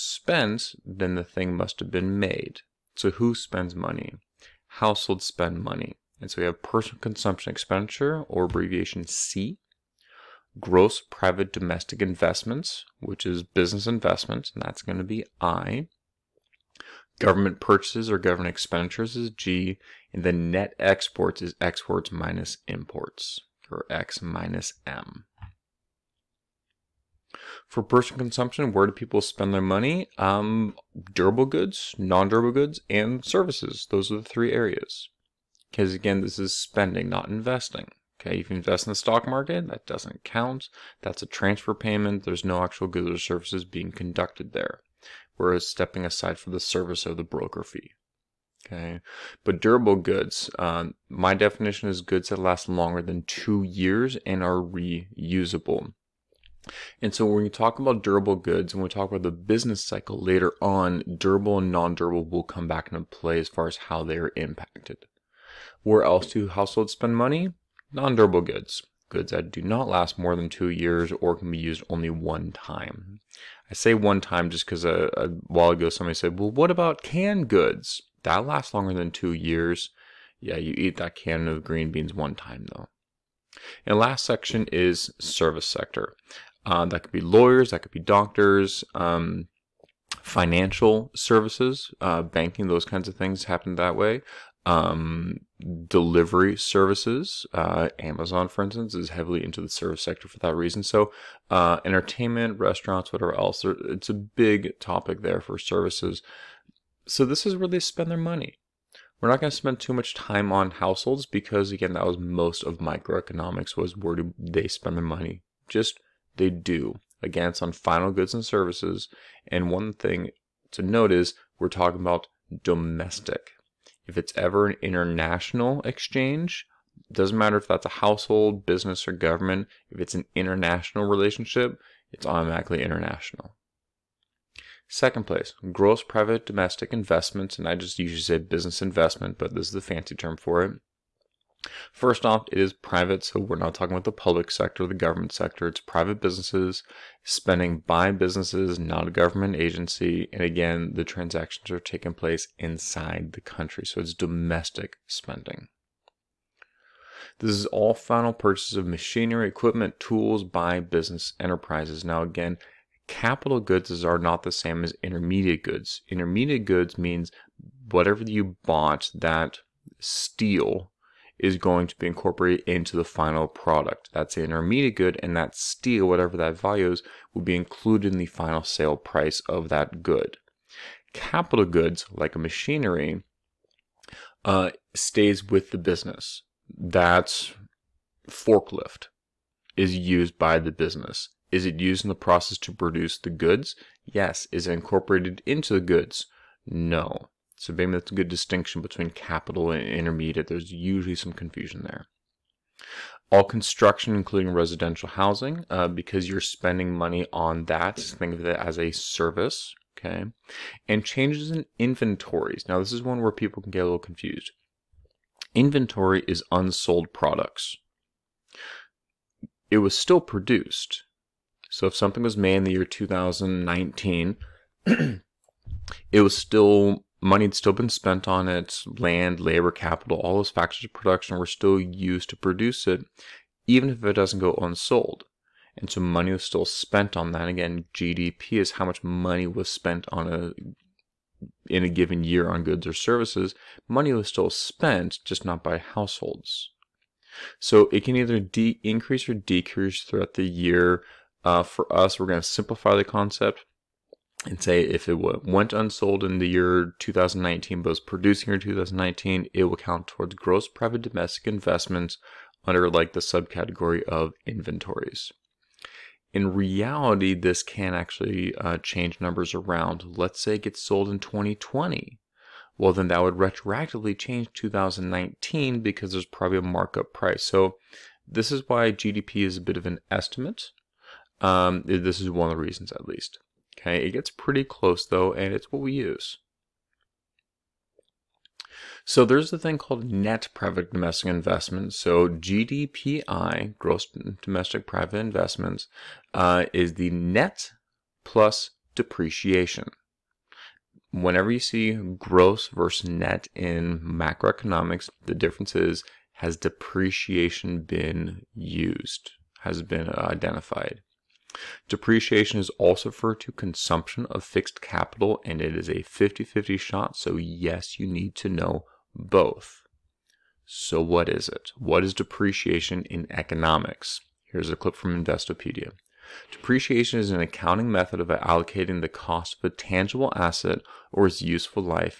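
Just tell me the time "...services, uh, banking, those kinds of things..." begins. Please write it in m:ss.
1:31.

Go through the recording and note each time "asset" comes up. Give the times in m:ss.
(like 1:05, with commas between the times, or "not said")
5:30.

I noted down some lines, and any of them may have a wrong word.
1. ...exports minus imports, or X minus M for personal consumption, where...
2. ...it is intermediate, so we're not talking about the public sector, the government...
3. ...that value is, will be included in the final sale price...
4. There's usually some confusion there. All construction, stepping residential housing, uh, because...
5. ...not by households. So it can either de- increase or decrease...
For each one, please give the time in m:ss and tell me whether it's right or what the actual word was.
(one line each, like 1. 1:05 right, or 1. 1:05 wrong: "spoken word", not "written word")
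1. 0:21 right
2. 2:22 wrong: "private", not "intermediate"
3. 2:56 right
4. 3:20 wrong: "including", not "stepping"
5. 4:05 right.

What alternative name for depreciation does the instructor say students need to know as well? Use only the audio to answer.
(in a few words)
Consumption of fixed capital.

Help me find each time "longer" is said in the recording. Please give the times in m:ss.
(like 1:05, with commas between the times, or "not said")
0:52, 1:18.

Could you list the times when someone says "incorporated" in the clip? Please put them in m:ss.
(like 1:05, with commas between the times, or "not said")
2:52, 3:14.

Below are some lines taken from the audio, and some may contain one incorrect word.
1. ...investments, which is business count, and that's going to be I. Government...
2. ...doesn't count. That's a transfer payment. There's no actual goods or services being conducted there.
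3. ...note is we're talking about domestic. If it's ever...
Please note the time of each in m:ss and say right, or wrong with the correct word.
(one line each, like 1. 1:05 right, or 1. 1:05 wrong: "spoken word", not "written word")
1. 0:12 wrong: "investment", not "count"
2. 0:39 right
3. 2:00 right.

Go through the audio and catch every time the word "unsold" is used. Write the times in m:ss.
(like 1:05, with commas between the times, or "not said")
3:36, 3:54, 4:15.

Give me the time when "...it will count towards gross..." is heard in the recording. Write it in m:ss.
4:19.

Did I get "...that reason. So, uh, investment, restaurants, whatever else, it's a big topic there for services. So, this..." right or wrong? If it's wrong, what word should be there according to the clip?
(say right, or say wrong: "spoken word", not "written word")
wrong: "entertainment", not "investment".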